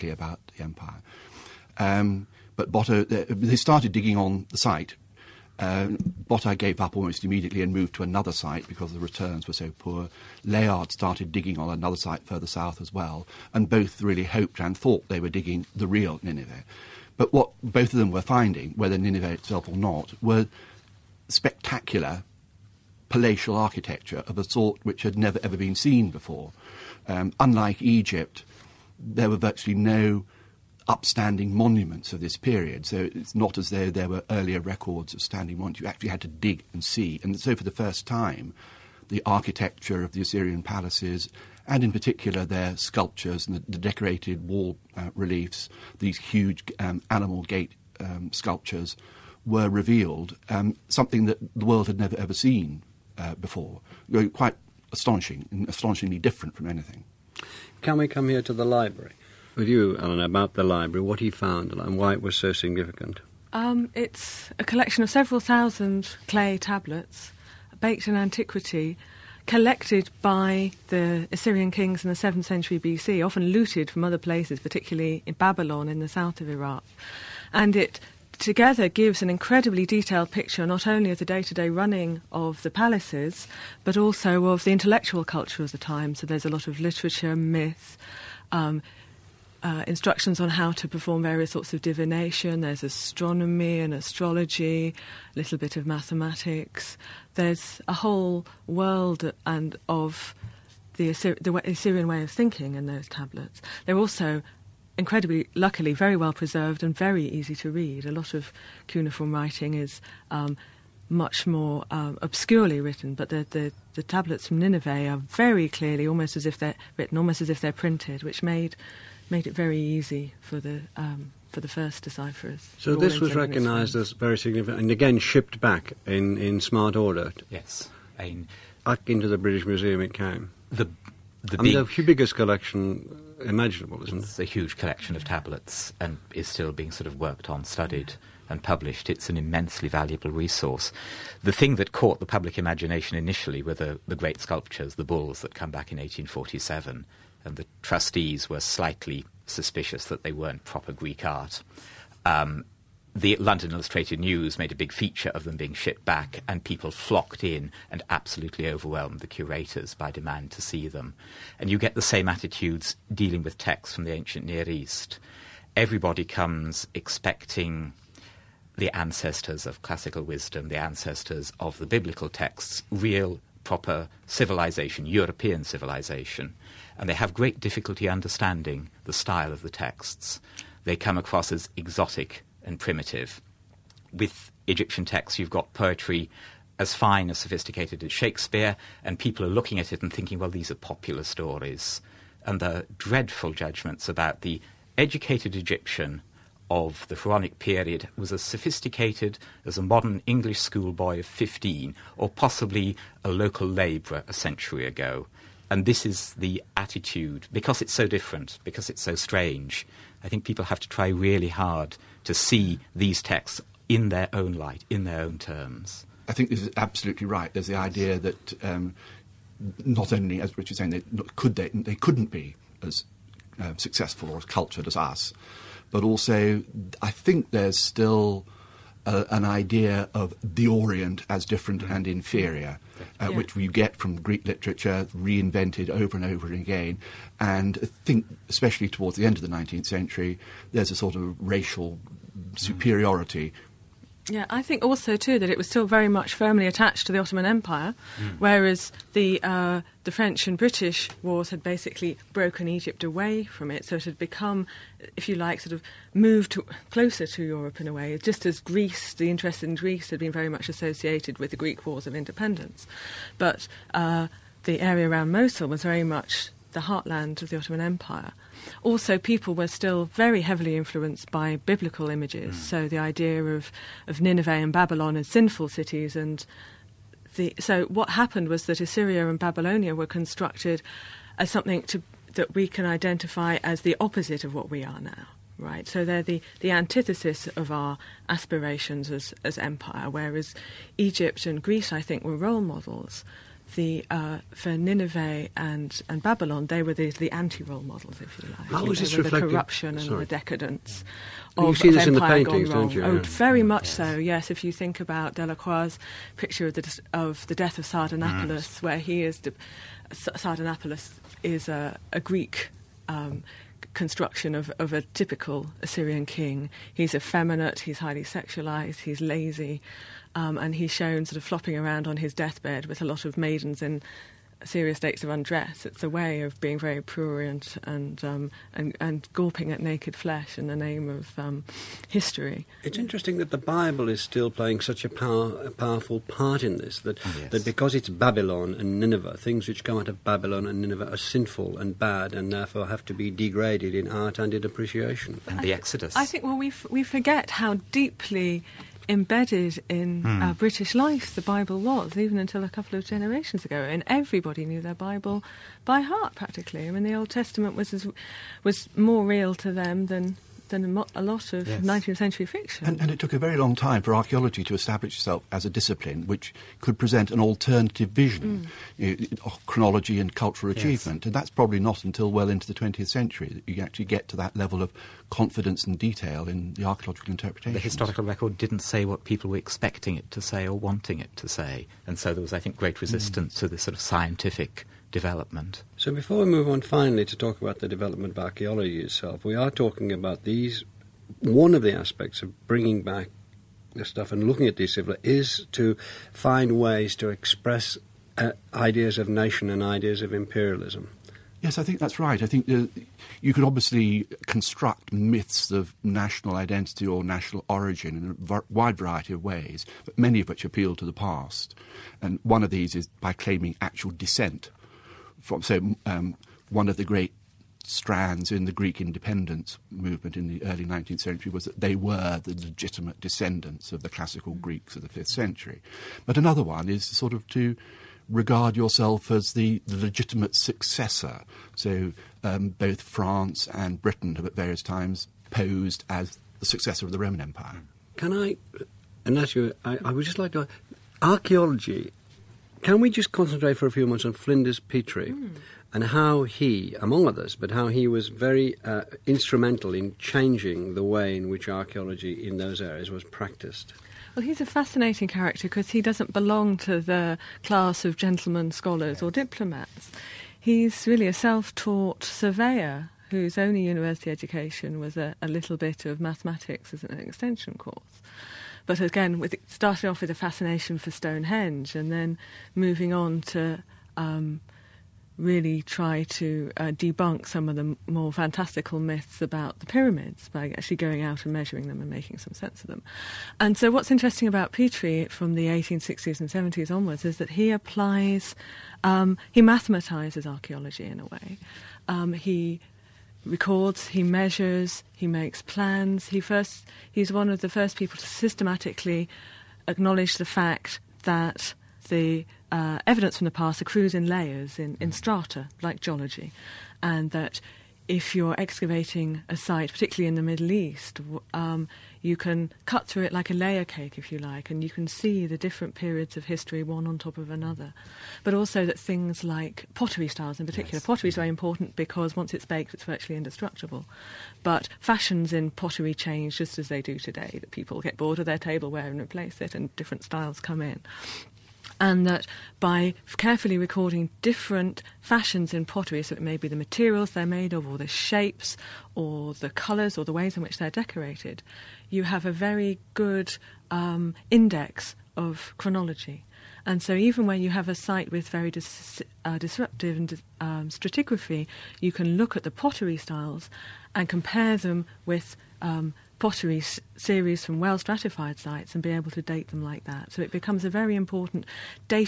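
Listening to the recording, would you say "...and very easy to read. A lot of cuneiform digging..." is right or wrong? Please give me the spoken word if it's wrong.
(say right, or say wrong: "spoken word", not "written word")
wrong: "writing", not "digging".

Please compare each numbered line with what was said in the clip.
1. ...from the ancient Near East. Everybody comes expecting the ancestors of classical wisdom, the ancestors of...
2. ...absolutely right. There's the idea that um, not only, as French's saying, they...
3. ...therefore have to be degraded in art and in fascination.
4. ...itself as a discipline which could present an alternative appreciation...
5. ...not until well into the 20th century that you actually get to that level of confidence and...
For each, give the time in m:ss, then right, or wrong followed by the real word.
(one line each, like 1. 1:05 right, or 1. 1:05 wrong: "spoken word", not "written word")
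1. 2:43 right
2. 3:36 wrong: "Richard", not "French"
3. 5:42 wrong: "appreciation", not "fascination"
4. 6:05 wrong: "vision", not "appreciation"
5. 6:11 right.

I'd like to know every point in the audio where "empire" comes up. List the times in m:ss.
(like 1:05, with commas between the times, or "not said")
0:00, 4:07, 4:27, 4:49, 7:17.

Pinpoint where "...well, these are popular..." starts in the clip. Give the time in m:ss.
3:10.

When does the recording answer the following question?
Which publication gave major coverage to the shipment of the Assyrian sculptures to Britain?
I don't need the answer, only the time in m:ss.
2:33.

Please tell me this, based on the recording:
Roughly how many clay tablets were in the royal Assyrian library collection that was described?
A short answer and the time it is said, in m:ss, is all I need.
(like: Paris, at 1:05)
several thousand, at 1:05.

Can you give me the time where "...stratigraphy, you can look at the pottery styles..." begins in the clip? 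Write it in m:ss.
9:10.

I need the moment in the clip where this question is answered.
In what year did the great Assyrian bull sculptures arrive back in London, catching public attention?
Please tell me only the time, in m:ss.
2:25.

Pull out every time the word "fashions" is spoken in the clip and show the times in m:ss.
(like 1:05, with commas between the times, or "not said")
8:44, 8:55.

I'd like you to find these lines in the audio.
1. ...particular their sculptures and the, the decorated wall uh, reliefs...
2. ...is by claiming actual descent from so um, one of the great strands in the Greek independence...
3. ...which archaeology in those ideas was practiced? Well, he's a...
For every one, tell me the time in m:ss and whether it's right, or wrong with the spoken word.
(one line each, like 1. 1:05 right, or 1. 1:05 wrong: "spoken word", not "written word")
1. 0:41 right
2. 6:52 right
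3. 7:31 wrong: "areas", not "ideas".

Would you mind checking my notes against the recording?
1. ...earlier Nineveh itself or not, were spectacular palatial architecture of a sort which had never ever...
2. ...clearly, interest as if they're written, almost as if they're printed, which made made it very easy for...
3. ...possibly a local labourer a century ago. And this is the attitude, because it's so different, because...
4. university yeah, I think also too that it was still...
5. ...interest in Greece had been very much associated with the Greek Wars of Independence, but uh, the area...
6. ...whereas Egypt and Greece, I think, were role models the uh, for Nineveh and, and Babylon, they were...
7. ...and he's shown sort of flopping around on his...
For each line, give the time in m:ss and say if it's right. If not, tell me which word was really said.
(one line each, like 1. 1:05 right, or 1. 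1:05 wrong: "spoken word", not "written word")
1. 0:18 wrong: "whether", not "earlier"
2. 1:55 wrong: "almost", not "interest"
3. 3:22 right
4. 4:02 wrong: "superiority", not "university"
5. 4:19 right
6. 4:50 right
7. 5:20 right.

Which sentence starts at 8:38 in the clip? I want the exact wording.
But also that things like pottery styles, in particular, yes.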